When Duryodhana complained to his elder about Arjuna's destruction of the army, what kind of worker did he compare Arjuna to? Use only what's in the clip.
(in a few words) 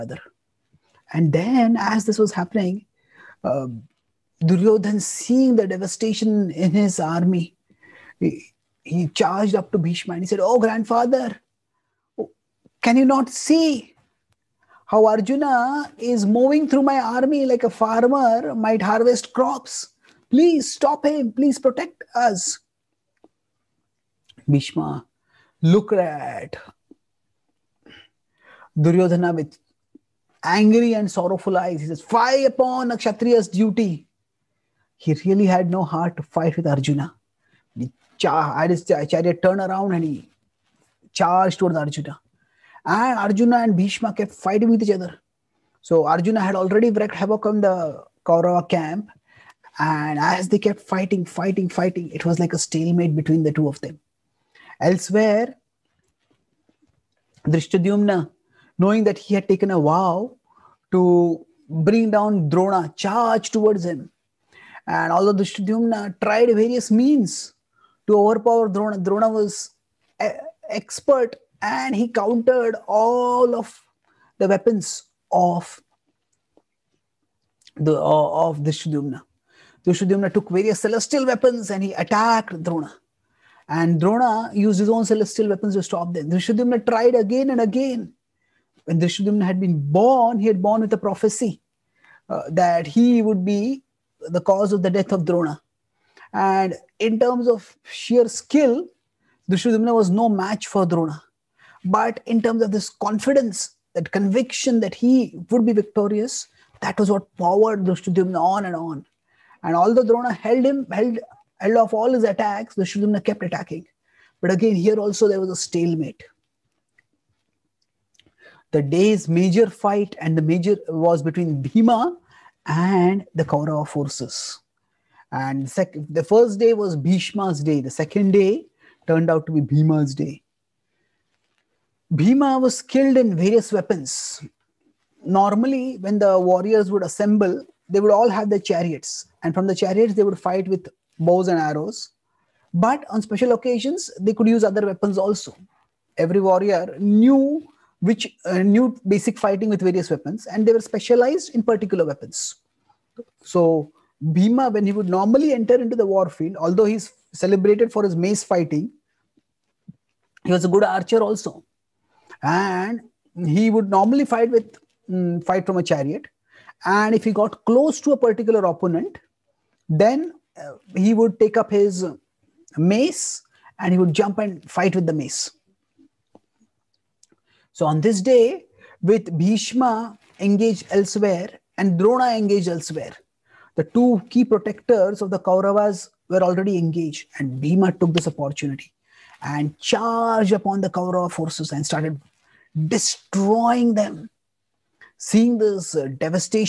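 A farmer.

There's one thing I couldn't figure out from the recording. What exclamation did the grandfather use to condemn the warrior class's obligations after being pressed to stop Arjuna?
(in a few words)
Fie upon a Kshatriya's duty.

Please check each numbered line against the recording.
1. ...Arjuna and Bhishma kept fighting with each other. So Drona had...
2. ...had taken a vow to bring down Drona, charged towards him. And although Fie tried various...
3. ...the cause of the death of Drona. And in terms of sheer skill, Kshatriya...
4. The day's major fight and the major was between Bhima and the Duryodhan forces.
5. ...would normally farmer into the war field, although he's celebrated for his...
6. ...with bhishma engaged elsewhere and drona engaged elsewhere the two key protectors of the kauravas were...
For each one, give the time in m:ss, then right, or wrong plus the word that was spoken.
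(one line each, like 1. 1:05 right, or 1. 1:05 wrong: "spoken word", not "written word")
1. 0:43 wrong: "Arjuna", not "Drona"
2. 0:59 wrong: "Drishtadyumna", not "Fie"
3. 1:34 wrong: "Drishtadyumna", not "Kshatriya"
4. 1:58 wrong: "Kaurava", not "Duryodhan"
5. 2:34 wrong: "enter", not "farmer"
6. 2:59 right.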